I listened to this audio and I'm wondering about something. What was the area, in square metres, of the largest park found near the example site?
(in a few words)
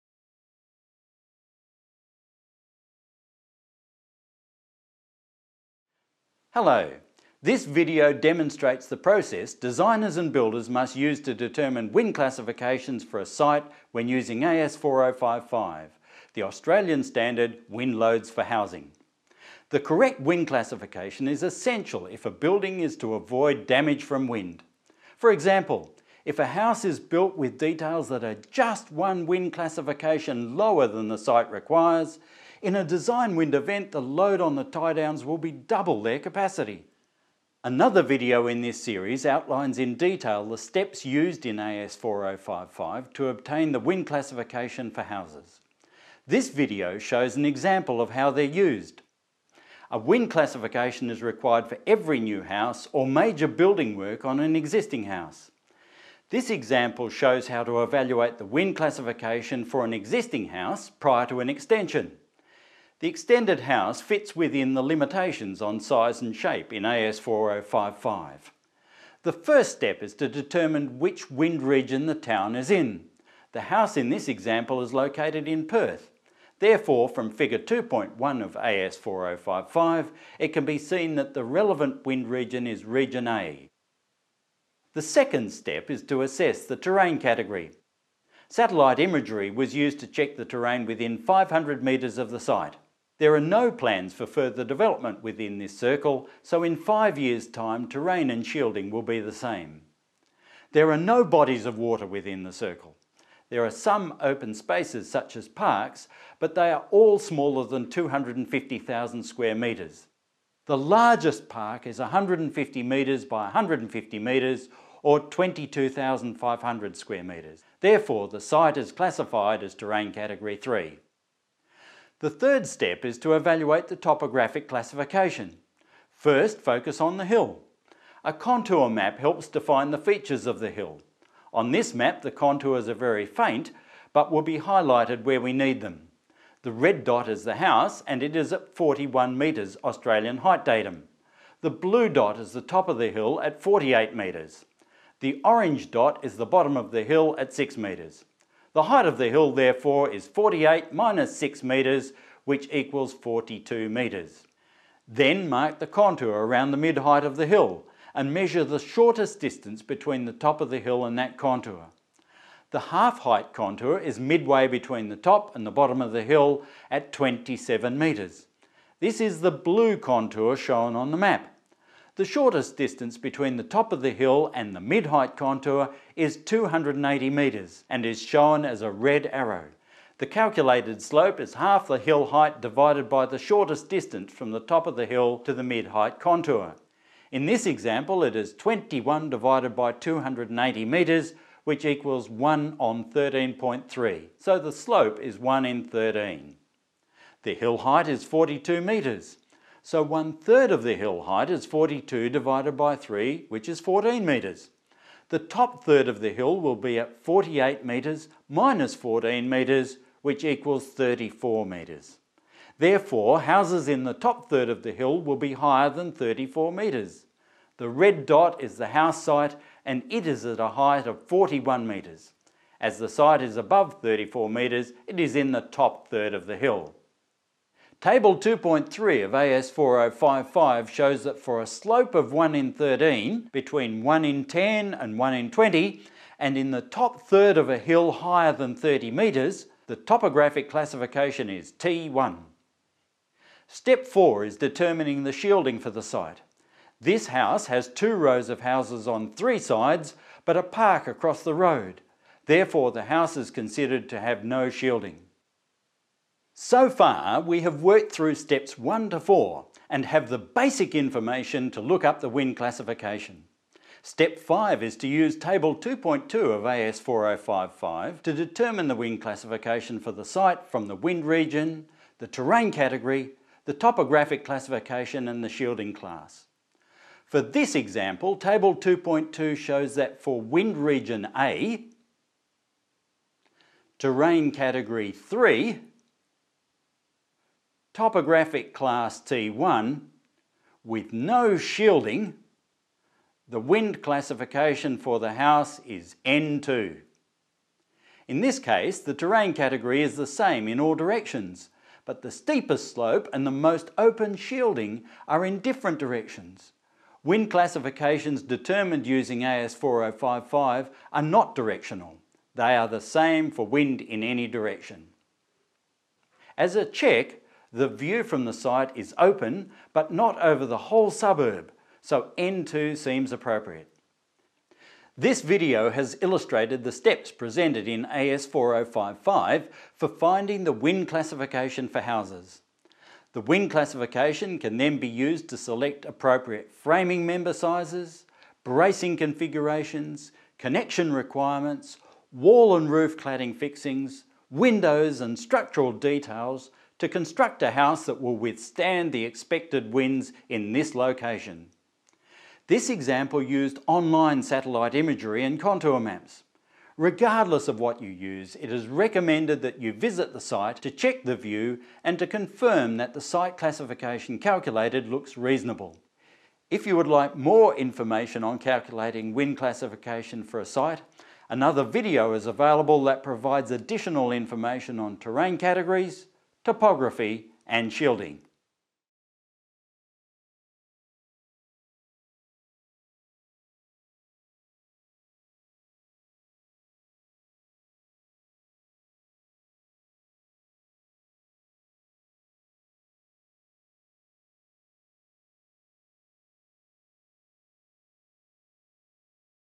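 22,500 square metres.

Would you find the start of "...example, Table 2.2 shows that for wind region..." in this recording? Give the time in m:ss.
4:37.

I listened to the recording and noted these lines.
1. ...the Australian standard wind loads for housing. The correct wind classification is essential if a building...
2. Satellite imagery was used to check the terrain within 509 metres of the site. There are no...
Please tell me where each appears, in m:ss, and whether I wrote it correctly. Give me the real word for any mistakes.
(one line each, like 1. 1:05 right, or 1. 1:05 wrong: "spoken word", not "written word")
1. 0:16 right
2. 1:28 wrong: "500", not "509".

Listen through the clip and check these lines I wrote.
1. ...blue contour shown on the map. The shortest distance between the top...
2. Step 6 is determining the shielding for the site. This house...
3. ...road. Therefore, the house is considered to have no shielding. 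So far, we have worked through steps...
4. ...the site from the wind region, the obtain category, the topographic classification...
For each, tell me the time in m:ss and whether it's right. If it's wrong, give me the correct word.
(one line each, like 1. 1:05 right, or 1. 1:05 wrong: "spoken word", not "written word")
1. 2:49 right
2. 4:03 wrong: "4", not "6"
3. 4:11 right
4. 4:30 wrong: "terrain", not "obtain".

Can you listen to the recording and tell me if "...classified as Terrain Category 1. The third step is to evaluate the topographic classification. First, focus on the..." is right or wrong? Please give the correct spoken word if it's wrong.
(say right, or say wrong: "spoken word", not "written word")
wrong: "3", not "1".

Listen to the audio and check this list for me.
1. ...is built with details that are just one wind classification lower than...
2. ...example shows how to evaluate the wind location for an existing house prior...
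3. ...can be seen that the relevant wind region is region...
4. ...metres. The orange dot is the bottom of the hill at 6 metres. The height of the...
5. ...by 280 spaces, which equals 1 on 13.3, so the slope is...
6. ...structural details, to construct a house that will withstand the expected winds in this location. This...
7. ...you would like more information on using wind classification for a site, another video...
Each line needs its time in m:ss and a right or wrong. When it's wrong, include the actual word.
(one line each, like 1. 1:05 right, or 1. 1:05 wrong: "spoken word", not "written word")
1. 0:26 right
2. 0:56 wrong: "classification", not "location"
3. 1:20 right
4. 2:24 right
5. 3:09 wrong: "metres", not "spaces"
6. 5:45 right
7. 6:06 wrong: "calculating", not "using".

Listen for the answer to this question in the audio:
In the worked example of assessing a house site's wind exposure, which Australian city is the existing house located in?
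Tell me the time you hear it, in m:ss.
1:15.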